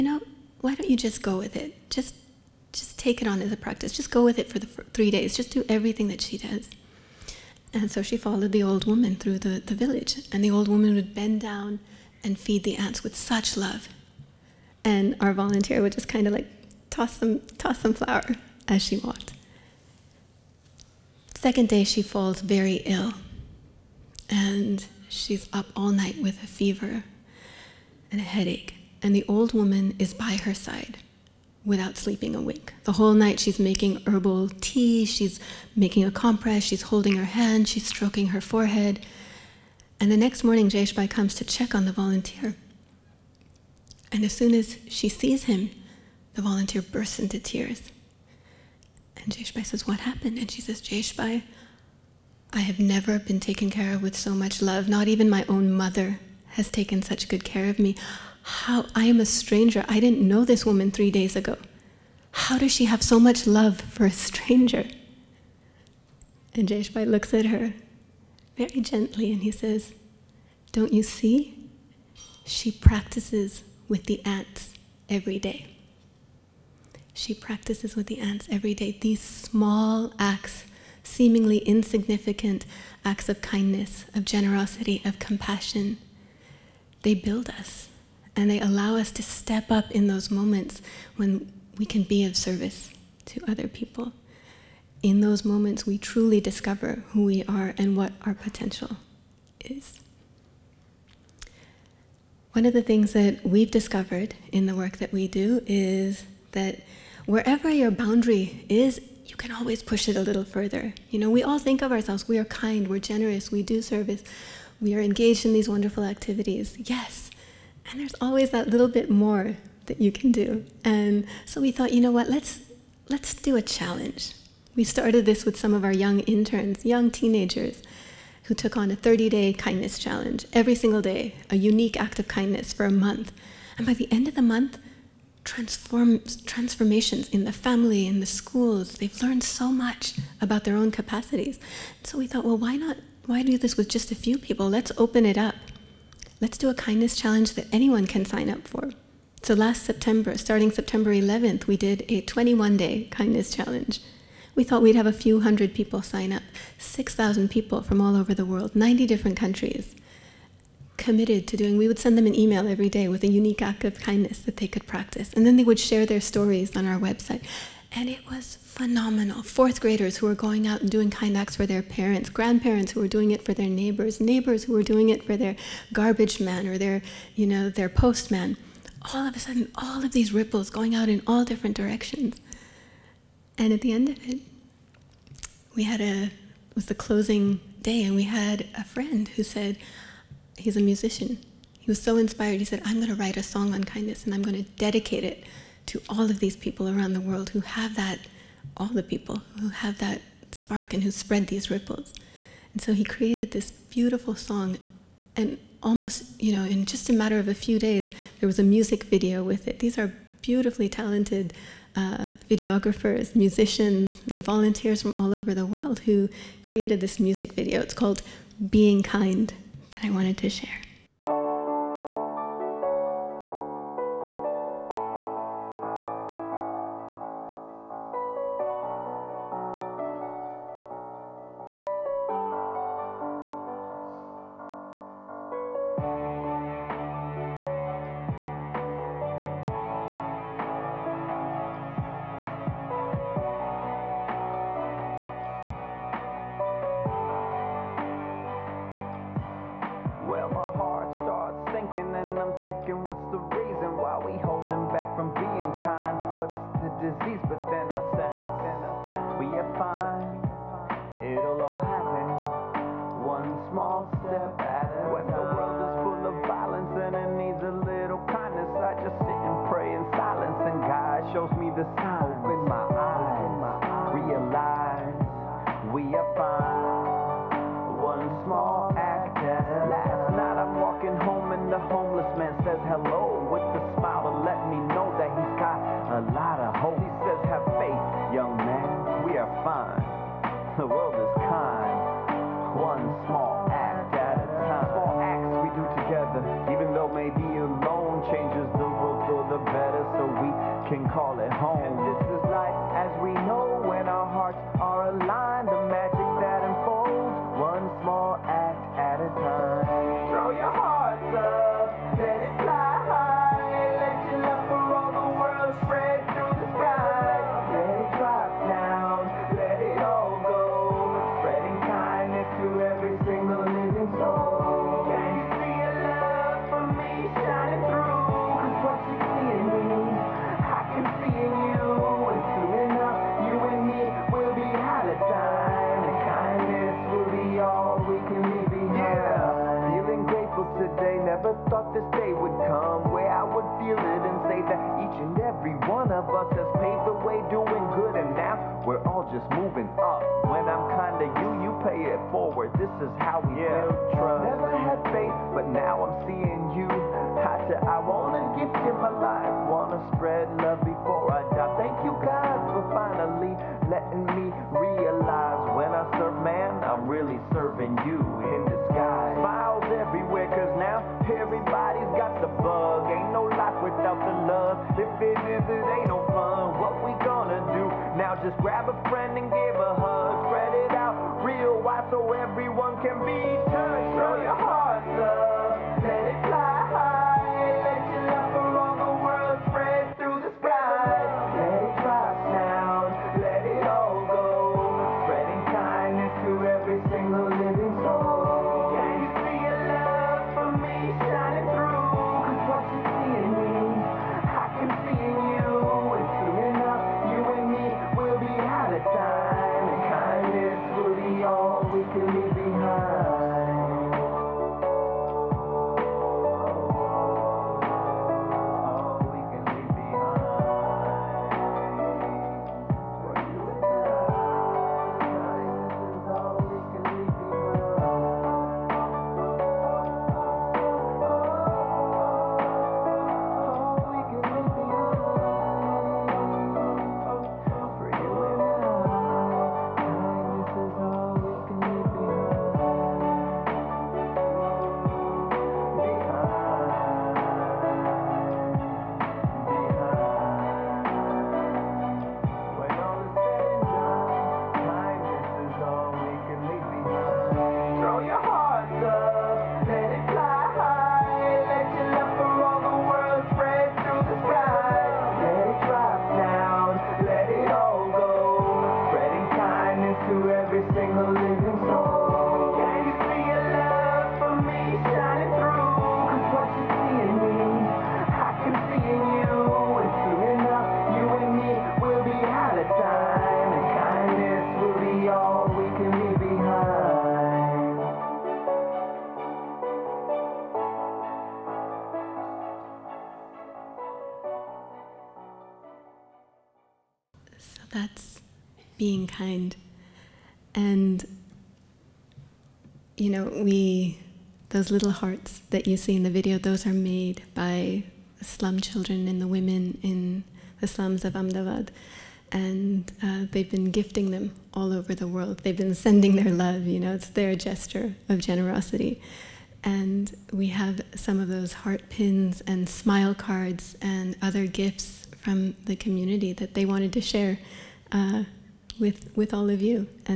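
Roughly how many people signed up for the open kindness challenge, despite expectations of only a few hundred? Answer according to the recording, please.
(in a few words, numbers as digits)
6,000.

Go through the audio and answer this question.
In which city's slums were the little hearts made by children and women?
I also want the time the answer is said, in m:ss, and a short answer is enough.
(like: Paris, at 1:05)
Ahmedabad, at 8:31.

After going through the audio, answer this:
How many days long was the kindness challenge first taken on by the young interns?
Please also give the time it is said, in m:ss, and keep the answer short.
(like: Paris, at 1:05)
30, at 2:08.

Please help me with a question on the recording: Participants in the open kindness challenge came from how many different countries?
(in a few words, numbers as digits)
90.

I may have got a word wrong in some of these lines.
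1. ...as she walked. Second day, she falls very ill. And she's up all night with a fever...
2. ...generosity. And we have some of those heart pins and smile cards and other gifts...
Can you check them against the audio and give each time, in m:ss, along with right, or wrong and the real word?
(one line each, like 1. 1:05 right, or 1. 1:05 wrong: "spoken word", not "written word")
1. 0:18 right
2. 8:38 right.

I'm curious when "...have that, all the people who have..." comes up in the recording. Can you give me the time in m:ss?
3:17.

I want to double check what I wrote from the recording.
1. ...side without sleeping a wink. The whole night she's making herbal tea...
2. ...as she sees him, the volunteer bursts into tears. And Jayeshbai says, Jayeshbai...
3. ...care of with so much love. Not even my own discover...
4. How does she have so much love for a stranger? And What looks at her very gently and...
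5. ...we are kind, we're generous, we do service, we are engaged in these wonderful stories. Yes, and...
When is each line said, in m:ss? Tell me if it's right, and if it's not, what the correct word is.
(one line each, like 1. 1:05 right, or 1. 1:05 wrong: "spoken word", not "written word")
1. 0:30 right
2. 0:44 wrong: "What", not "Jayeshbai"
3. 0:53 wrong: "mother", not "discover"
4. 1:02 wrong: "Jayeshbai", not "What"
5. 1:52 wrong: "activities", not "stories".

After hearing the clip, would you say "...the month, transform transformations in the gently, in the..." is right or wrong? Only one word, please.
wrong.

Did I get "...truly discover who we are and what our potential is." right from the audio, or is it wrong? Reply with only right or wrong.
right.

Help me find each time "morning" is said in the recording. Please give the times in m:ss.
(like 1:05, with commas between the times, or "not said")
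0:40.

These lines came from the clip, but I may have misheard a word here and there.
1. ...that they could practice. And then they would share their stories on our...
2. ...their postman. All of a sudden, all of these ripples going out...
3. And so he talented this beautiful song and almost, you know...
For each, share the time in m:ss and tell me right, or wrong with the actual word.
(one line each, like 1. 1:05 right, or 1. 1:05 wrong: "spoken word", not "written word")
1. 2:44 right
2. 2:57 right
3. 3:22 wrong: "created", not "talented".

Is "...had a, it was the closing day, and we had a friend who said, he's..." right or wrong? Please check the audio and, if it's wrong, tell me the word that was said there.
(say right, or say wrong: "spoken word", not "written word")
right.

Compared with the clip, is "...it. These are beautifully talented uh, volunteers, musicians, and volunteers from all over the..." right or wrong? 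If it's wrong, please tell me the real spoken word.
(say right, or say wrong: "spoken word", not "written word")
wrong: "videographers", not "volunteers".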